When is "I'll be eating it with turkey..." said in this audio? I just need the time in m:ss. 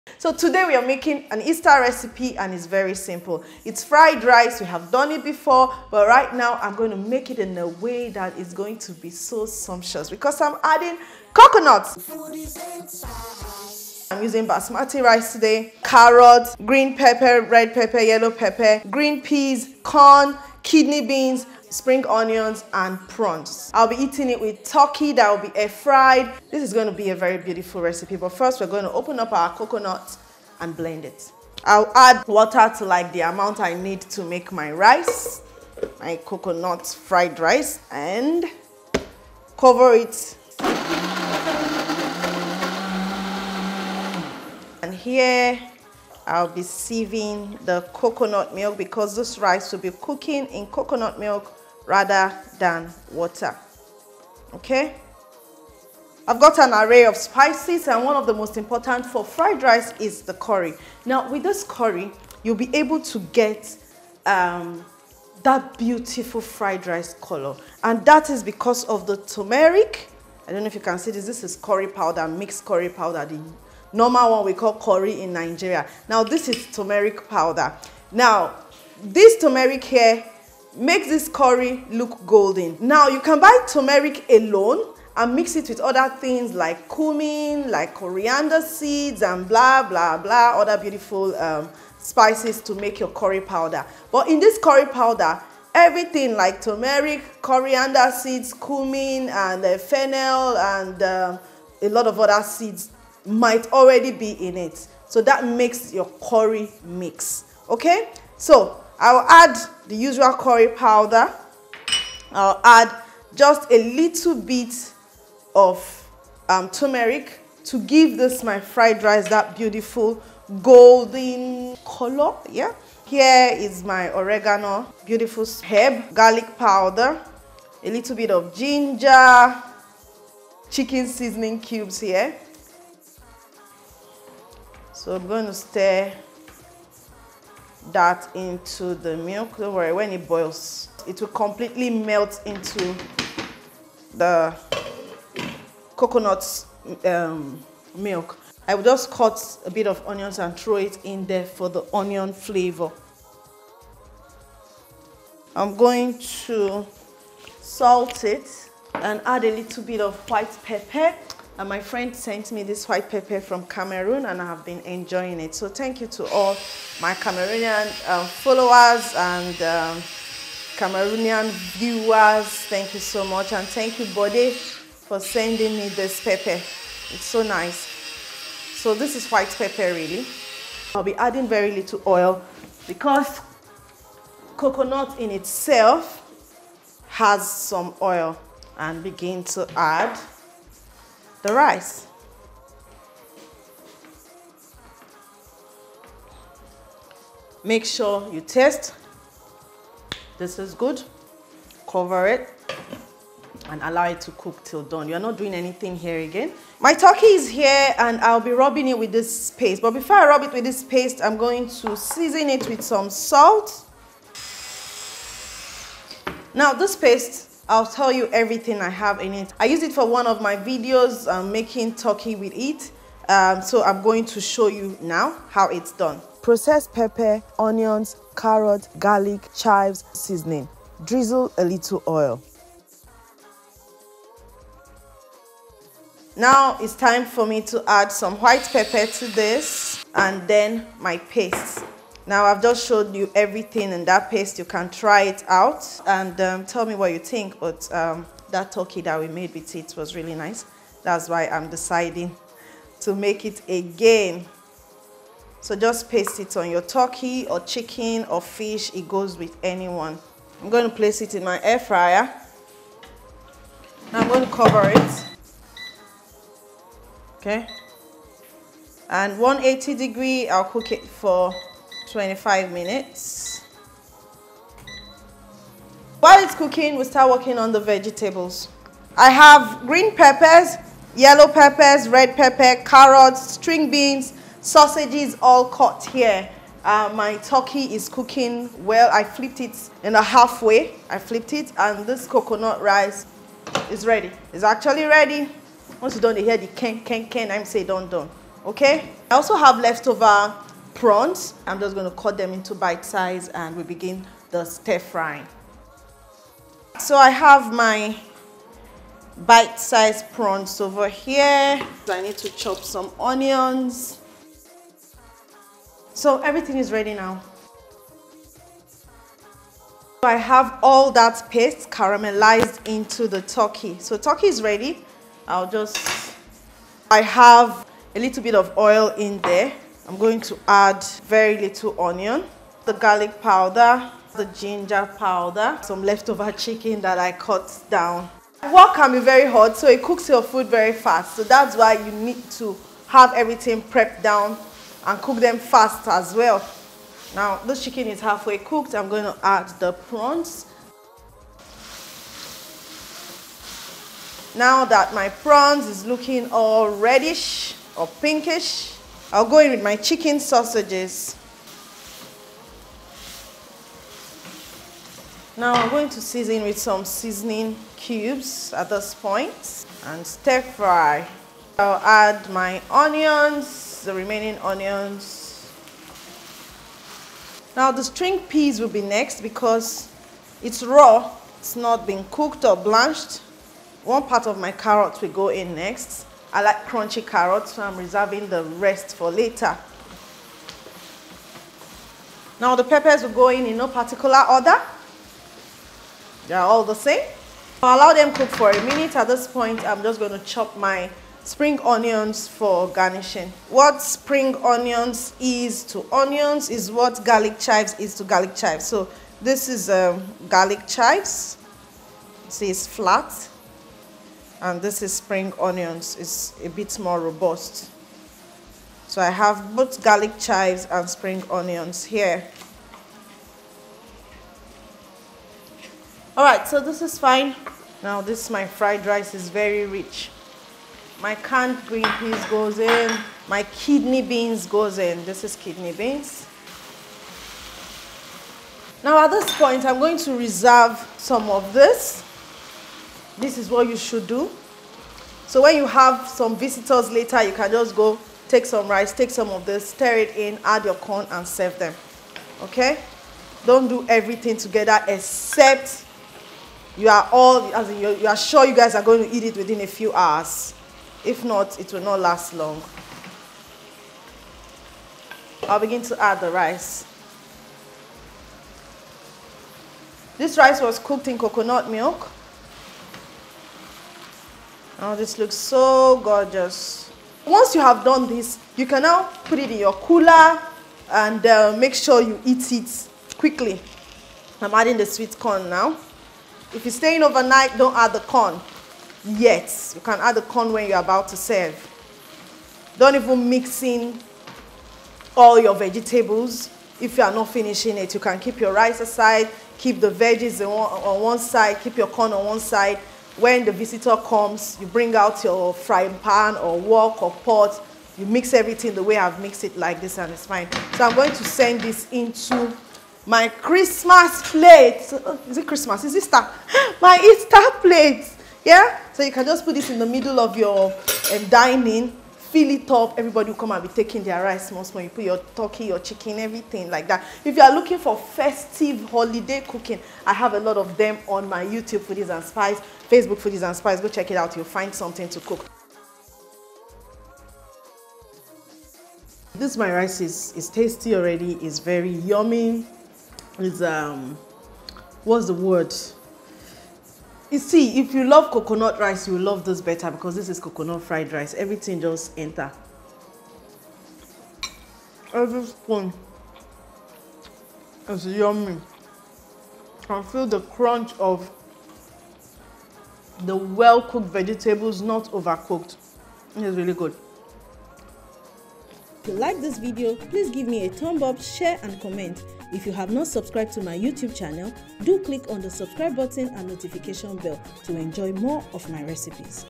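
0:23.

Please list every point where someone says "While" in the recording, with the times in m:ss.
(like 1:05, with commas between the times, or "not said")
4:36.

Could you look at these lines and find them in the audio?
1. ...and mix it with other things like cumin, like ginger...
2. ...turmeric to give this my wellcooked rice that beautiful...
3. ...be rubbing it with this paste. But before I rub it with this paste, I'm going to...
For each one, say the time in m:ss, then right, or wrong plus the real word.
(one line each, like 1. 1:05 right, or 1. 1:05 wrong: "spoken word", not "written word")
1. 1:25 wrong: "coriander", not "ginger"
2. 1:56 wrong: "fried", not "wellcooked"
3. 3:28 right.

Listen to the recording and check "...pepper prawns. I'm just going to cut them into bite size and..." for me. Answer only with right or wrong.
wrong.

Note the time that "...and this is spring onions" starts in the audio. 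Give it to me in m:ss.
6:54.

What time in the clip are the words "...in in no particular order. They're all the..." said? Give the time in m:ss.
6:33.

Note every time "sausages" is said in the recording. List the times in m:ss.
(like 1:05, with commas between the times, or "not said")
4:44, 6:00.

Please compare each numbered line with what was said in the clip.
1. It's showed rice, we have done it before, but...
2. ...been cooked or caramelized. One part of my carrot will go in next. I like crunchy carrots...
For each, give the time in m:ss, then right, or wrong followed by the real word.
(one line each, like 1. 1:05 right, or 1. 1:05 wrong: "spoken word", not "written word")
1. 0:03 wrong: "fried", not "showed"
2. 6:22 wrong: "blanched", not "caramelized".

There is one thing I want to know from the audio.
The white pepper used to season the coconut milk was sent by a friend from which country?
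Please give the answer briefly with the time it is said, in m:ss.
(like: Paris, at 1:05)
Cameroon, at 2:43.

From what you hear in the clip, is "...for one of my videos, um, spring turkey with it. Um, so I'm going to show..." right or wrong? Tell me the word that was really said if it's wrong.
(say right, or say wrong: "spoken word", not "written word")
wrong: "making", not "spring".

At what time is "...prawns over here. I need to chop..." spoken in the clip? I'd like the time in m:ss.
5:10.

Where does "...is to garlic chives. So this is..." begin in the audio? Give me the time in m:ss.
6:47.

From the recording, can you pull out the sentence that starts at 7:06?
All right, so this is fine.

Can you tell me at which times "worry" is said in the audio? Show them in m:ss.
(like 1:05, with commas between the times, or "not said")
2:19.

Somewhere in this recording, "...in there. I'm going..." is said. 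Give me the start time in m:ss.
5:29.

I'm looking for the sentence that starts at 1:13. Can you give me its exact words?
The normal one we call curry in Nigeria.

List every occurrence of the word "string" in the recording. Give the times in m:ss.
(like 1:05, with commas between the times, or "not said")
4:43, 6:18.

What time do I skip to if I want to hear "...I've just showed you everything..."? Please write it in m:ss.
4:02.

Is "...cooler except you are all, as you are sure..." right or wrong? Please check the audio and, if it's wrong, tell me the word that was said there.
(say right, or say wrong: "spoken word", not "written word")
wrong: "together", not "cooler".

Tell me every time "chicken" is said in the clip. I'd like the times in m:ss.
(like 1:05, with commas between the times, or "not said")
2:10, 4:17, 5:36, 5:47, 5:59, 8:45.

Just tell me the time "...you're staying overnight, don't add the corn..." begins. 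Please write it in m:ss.
8:06.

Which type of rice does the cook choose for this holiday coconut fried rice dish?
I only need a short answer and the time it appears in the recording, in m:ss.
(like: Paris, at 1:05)
Basmati, at 0:14.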